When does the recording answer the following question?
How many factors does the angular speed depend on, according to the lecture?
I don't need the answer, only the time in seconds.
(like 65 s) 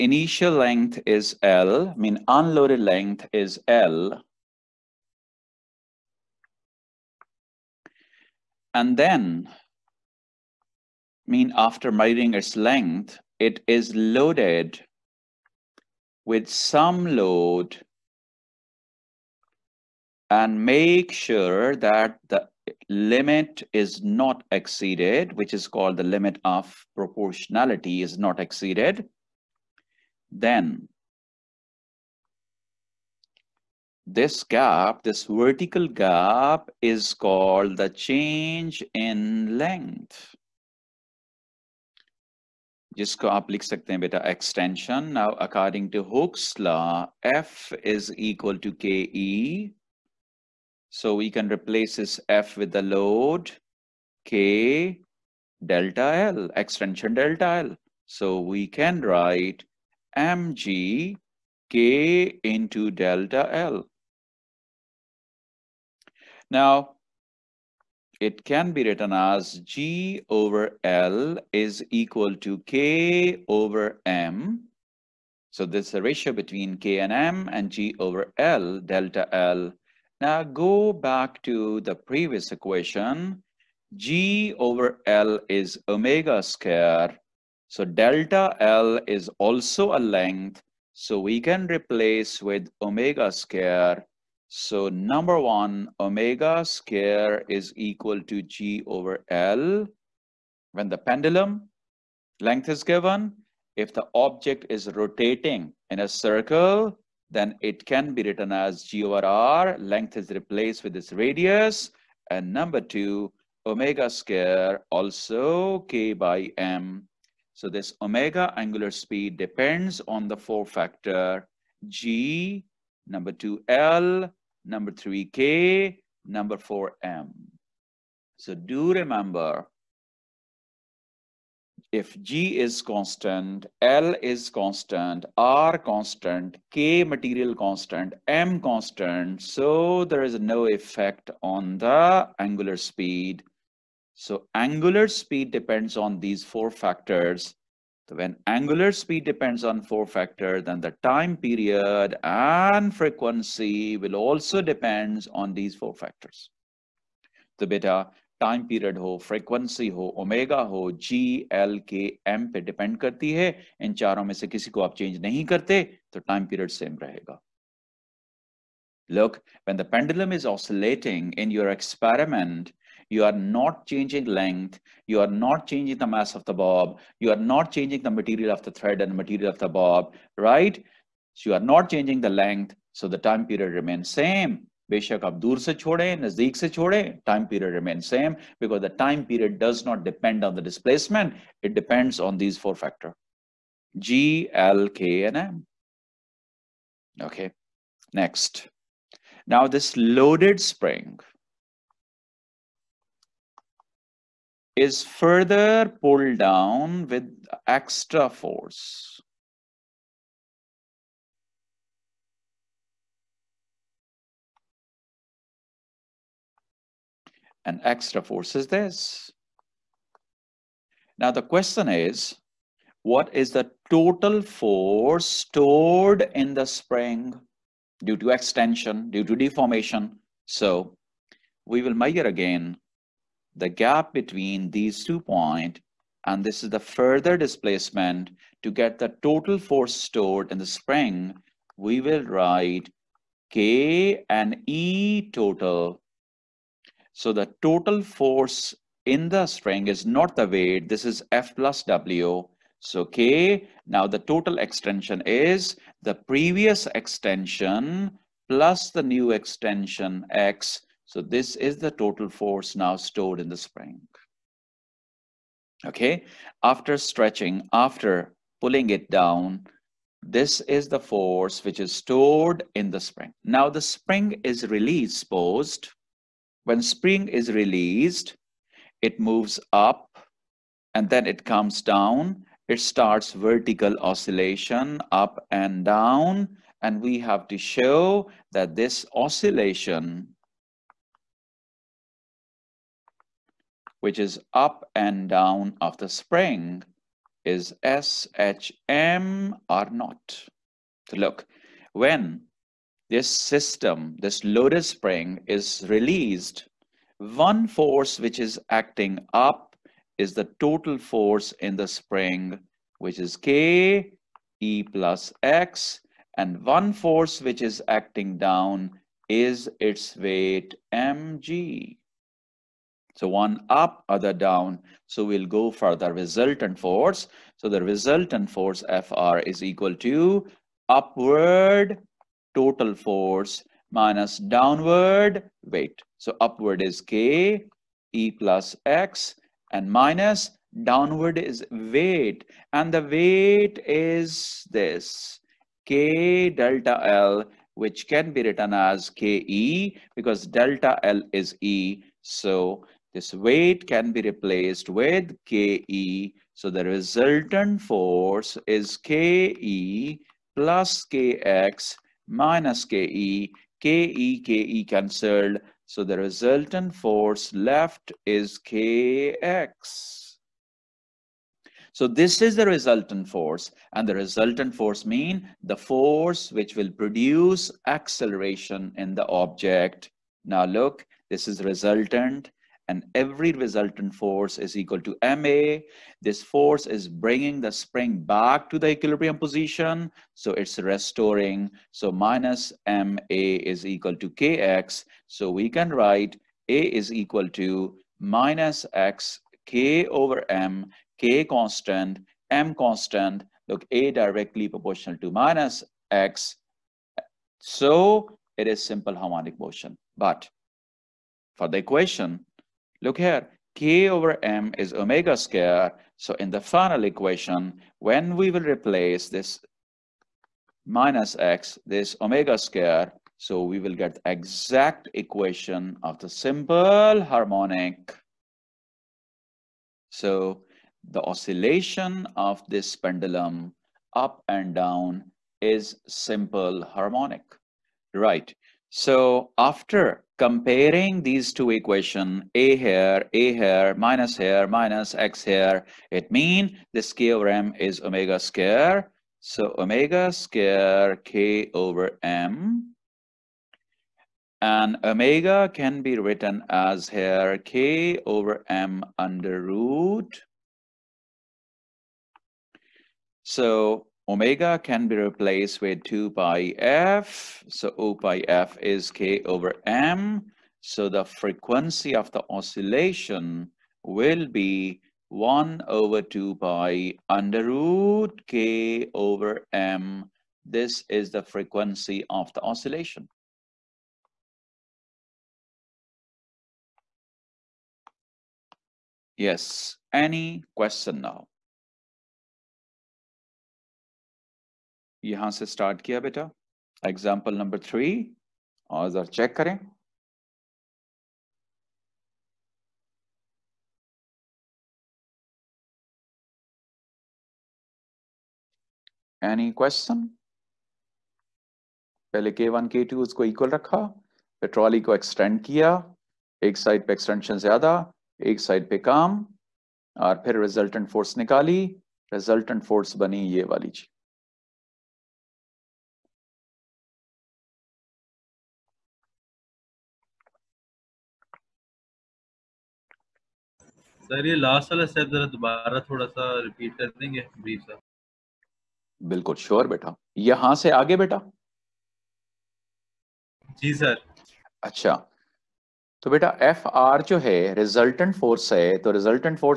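120 s.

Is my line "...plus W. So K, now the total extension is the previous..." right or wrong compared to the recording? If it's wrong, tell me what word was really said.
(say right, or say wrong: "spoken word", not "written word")
right.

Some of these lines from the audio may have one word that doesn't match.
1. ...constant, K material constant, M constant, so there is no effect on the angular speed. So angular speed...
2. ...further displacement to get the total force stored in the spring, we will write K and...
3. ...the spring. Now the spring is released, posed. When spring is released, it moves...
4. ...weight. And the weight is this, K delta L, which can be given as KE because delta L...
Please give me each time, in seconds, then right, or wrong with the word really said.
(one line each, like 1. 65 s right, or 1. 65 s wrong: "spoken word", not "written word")
1. 135 s right
2. 236 s right
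3. 272 s right
4. 341 s wrong: "written", not "given".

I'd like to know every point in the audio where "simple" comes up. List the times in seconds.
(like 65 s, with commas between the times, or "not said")
408 s, 426 s, 436 s.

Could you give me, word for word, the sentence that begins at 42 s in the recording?
जिसको आप लिख सकते हैं बेटा extension.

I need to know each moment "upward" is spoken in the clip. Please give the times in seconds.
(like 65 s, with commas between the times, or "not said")
330 s, 336 s.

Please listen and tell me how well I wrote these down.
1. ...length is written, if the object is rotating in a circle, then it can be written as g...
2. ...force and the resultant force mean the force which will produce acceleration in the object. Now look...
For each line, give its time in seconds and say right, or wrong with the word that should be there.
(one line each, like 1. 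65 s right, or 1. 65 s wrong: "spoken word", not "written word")
1. 102 s wrong: "given", not "written"
2. 373 s right.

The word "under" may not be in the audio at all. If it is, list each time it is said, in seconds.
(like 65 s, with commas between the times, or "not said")
459 s, 477 s.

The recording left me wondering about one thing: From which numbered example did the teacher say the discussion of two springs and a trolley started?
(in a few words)
example number 3.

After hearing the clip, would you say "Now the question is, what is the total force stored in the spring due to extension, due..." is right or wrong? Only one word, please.
right.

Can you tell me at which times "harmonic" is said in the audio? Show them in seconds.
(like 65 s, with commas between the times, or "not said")
409 s, 427 s, 436 s.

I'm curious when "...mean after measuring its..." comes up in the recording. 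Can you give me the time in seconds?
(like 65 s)
11 s.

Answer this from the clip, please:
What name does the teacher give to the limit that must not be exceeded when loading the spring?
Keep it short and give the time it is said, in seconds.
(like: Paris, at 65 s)
limit of proportionality, at 26 s.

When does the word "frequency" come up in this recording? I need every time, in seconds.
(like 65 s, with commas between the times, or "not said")
152 s, 471 s, 481 s.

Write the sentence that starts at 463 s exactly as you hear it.
So omega can be replaced with 2 pi f.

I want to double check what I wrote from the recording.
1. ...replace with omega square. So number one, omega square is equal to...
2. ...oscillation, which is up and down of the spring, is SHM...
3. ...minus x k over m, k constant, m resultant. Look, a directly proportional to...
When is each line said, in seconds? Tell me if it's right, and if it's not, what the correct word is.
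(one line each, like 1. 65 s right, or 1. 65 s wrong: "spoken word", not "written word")
1. 91 s right
2. 289 s right
3. 398 s wrong: "constant", not "resultant".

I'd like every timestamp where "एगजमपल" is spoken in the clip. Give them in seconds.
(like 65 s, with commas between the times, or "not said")
497 s.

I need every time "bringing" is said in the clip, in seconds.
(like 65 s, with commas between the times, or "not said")
387 s.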